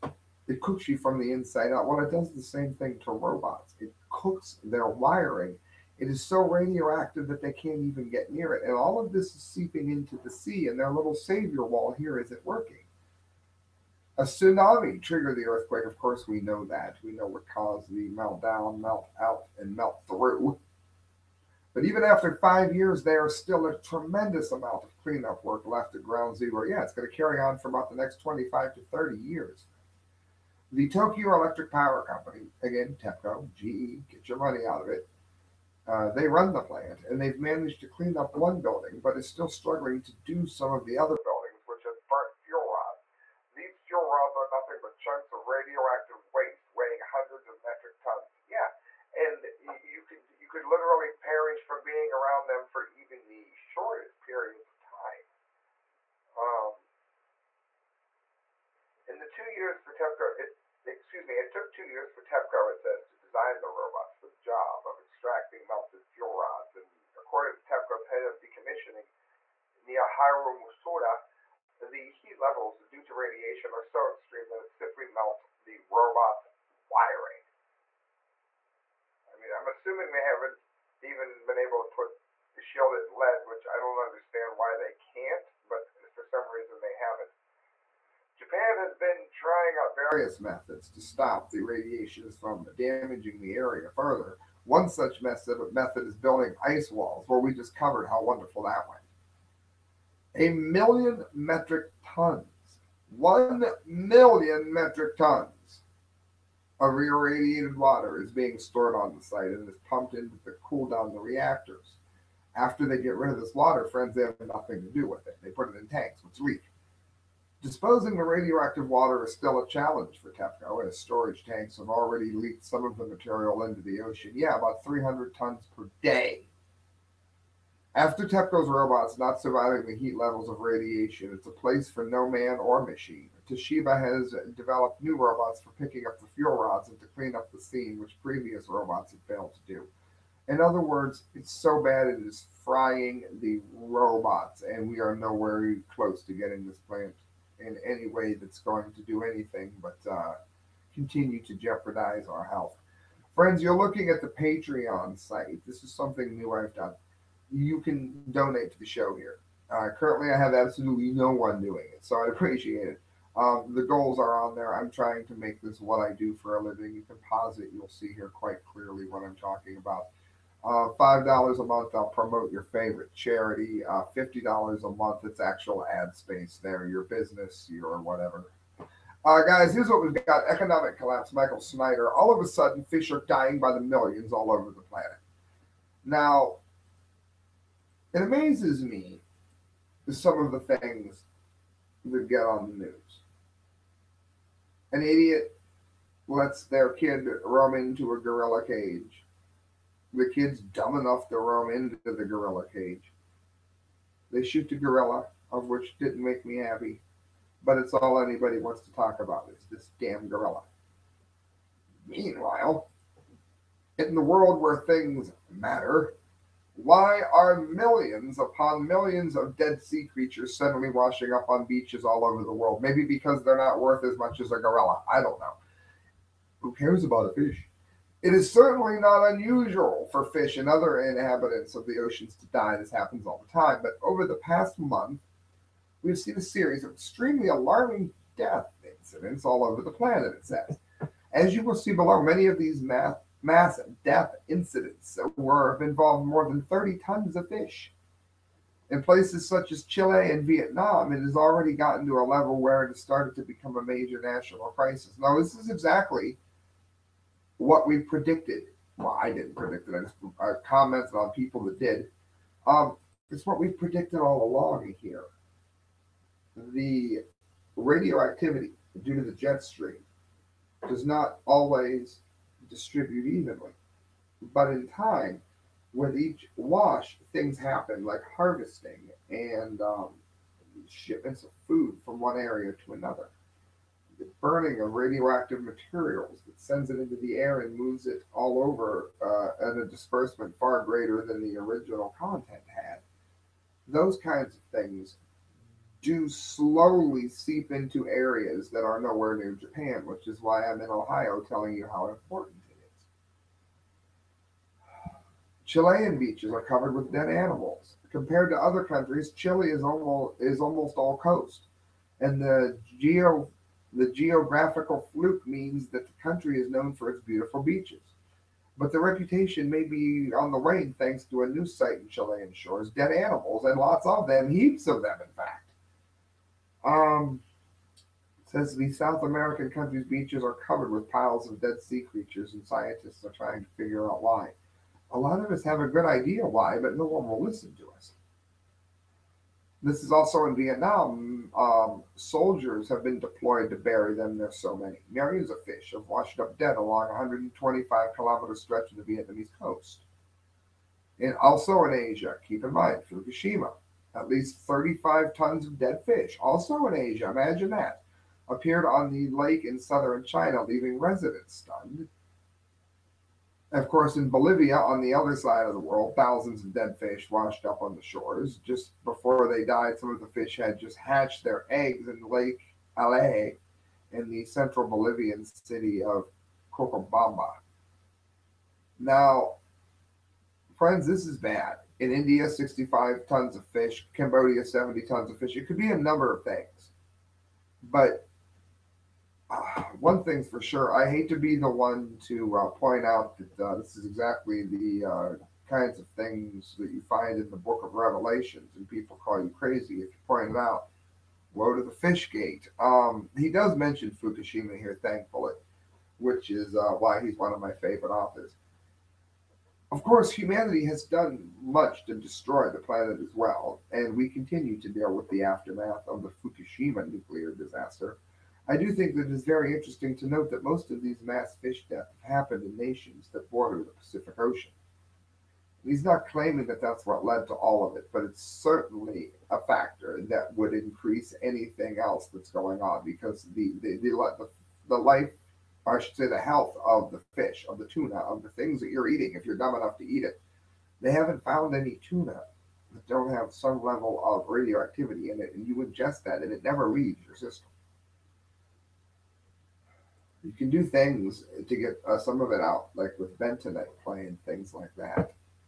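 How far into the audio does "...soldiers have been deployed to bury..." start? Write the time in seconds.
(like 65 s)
342 s.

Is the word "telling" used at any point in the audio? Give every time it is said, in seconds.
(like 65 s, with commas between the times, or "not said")
301 s.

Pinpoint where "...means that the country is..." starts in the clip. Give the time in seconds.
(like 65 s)
315 s.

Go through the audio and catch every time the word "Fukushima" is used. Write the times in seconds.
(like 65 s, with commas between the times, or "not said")
353 s, 404 s, 416 s.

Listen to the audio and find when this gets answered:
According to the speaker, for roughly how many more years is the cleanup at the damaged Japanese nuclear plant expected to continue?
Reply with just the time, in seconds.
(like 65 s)
28 s.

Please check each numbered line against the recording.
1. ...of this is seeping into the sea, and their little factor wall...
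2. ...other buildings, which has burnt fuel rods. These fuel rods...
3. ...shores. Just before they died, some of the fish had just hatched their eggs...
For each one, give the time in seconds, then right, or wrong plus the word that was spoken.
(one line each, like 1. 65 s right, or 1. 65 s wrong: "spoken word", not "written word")
1. 8 s wrong: "savior", not "factor"
2. 40 s right
3. 368 s right.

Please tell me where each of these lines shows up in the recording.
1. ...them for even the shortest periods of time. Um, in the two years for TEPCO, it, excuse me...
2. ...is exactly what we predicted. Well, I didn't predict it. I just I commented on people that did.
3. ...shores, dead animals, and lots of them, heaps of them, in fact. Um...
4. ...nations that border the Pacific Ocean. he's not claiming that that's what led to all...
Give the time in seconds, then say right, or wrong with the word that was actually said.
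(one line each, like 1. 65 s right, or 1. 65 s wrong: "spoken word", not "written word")
1. 52 s right
2. 255 s right
3. 322 s right
4. 422 s right.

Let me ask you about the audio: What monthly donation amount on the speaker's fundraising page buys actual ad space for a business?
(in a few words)
$50.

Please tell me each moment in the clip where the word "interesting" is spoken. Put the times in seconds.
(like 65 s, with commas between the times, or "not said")
419 s.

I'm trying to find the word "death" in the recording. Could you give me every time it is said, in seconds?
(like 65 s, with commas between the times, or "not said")
238 s, 244 s, 421 s.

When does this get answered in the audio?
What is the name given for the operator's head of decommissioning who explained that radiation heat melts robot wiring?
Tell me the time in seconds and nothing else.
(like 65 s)
69 s.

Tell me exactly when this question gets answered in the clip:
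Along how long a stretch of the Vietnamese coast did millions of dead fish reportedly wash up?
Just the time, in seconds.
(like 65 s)
347 s.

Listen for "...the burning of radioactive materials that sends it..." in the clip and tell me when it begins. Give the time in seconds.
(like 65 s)
284 s.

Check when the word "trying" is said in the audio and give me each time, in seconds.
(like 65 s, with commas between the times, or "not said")
89 s, 164 s, 333 s.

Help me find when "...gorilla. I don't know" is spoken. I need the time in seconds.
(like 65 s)
224 s.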